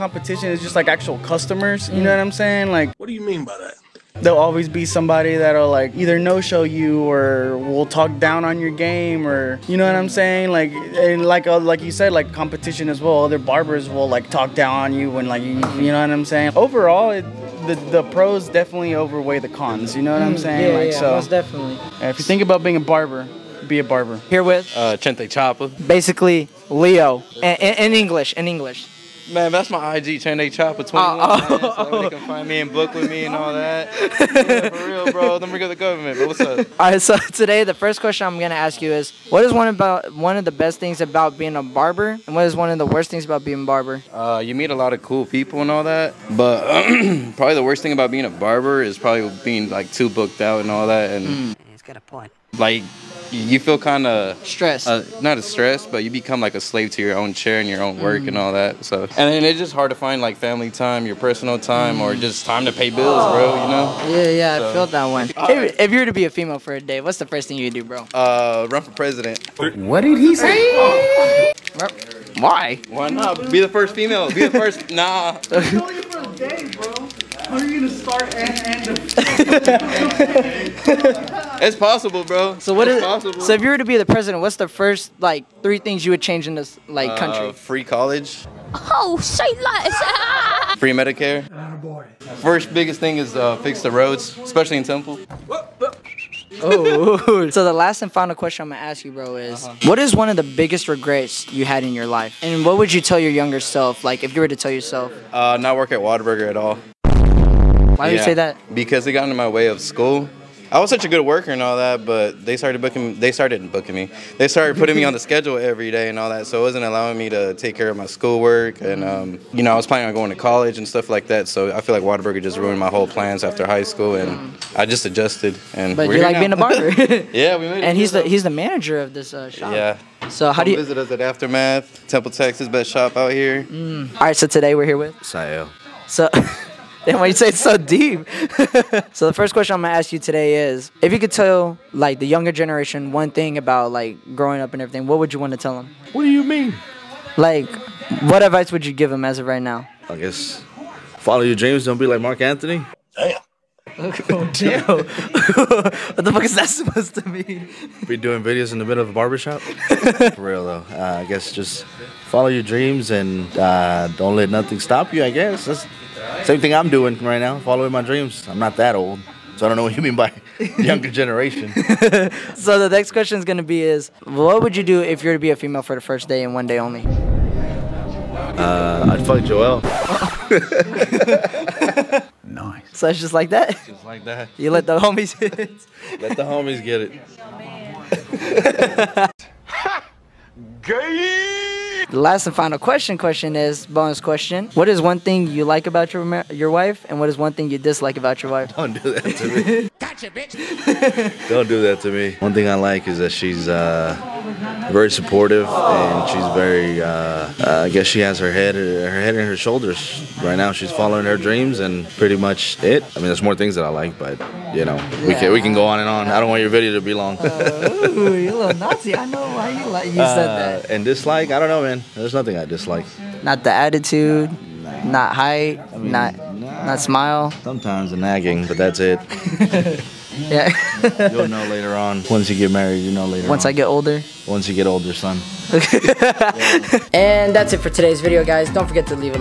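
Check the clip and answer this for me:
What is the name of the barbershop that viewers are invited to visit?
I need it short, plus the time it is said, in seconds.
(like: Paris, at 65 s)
Aftermath, at 131 s.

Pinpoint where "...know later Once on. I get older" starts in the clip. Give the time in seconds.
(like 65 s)
233 s.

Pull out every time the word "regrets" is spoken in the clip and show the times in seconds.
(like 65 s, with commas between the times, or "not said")
100 s.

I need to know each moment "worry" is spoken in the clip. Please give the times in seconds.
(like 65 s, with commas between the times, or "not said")
not said.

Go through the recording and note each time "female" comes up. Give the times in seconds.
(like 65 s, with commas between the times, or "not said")
66 s, 73 s, 175 s.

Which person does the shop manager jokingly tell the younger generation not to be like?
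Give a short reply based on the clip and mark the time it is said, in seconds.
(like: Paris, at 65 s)
Marc Anthony, at 152 s.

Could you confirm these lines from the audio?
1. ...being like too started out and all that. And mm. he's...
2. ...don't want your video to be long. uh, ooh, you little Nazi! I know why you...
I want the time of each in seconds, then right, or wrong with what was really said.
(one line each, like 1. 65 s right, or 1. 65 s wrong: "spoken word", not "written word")
1. 49 s wrong: "booked", not "started"
2. 216 s right.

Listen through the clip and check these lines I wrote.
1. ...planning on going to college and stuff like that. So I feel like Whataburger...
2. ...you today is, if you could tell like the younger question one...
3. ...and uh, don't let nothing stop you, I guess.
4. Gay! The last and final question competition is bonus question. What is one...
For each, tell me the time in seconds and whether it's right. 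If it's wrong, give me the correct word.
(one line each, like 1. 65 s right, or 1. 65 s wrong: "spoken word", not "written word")
1. 119 s right
2. 140 s wrong: "generation", not "question"
3. 163 s right
4. 190 s wrong: "question", not "competition".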